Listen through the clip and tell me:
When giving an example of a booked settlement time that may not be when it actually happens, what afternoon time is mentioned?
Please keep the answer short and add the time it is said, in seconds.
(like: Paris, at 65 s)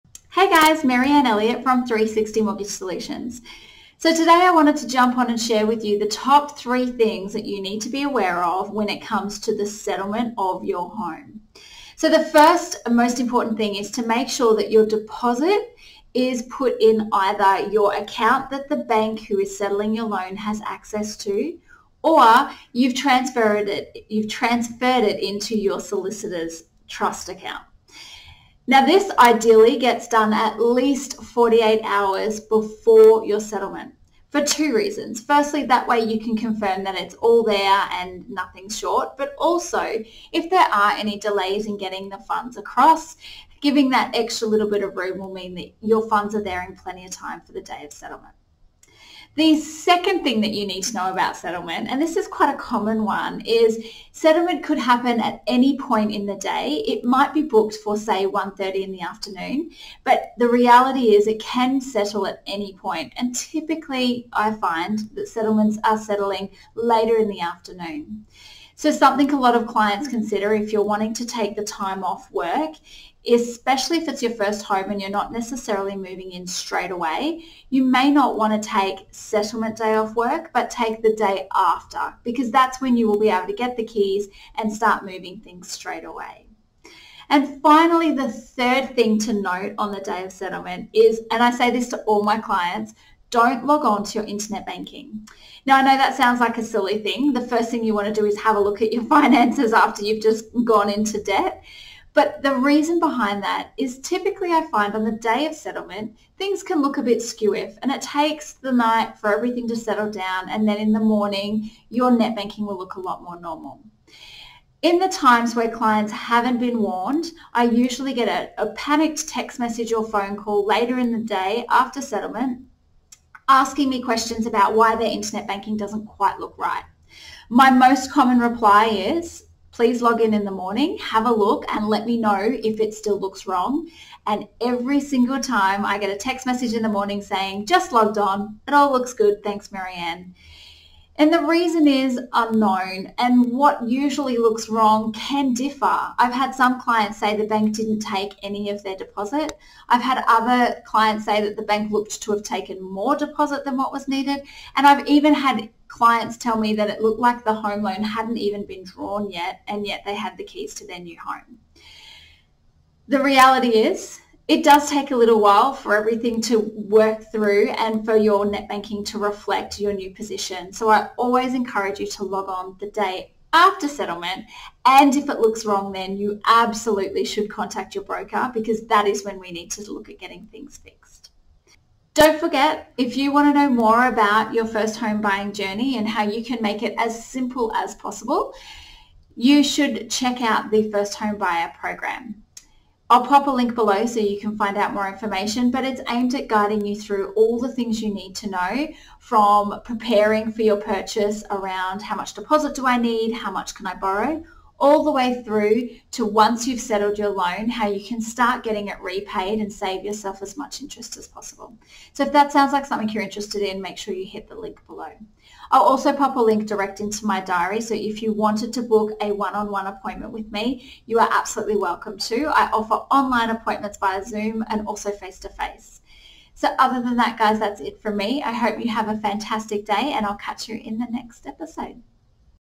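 1:30, at 58 s.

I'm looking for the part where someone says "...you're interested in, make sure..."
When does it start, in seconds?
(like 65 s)
213 s.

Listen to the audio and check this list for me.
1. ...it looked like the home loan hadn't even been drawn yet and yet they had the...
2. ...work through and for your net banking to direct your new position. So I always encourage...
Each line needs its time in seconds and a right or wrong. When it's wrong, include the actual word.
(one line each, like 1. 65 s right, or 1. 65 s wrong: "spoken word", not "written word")
1. 156 s right
2. 166 s wrong: "reflect", not "direct".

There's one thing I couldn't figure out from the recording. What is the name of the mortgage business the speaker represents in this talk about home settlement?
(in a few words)
360 Mortgage Solutions.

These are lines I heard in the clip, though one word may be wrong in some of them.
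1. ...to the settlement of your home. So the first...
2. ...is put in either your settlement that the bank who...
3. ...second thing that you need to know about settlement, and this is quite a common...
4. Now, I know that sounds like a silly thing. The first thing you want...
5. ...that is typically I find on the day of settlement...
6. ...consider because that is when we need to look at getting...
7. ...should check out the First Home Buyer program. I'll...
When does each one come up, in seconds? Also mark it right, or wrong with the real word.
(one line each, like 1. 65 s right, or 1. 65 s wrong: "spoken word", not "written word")
1. 9 s right
2. 16 s wrong: "account", not "settlement"
3. 49 s right
4. 95 s right
5. 103 s right
6. 178 s wrong: "broker", not "consider"
7. 189 s right.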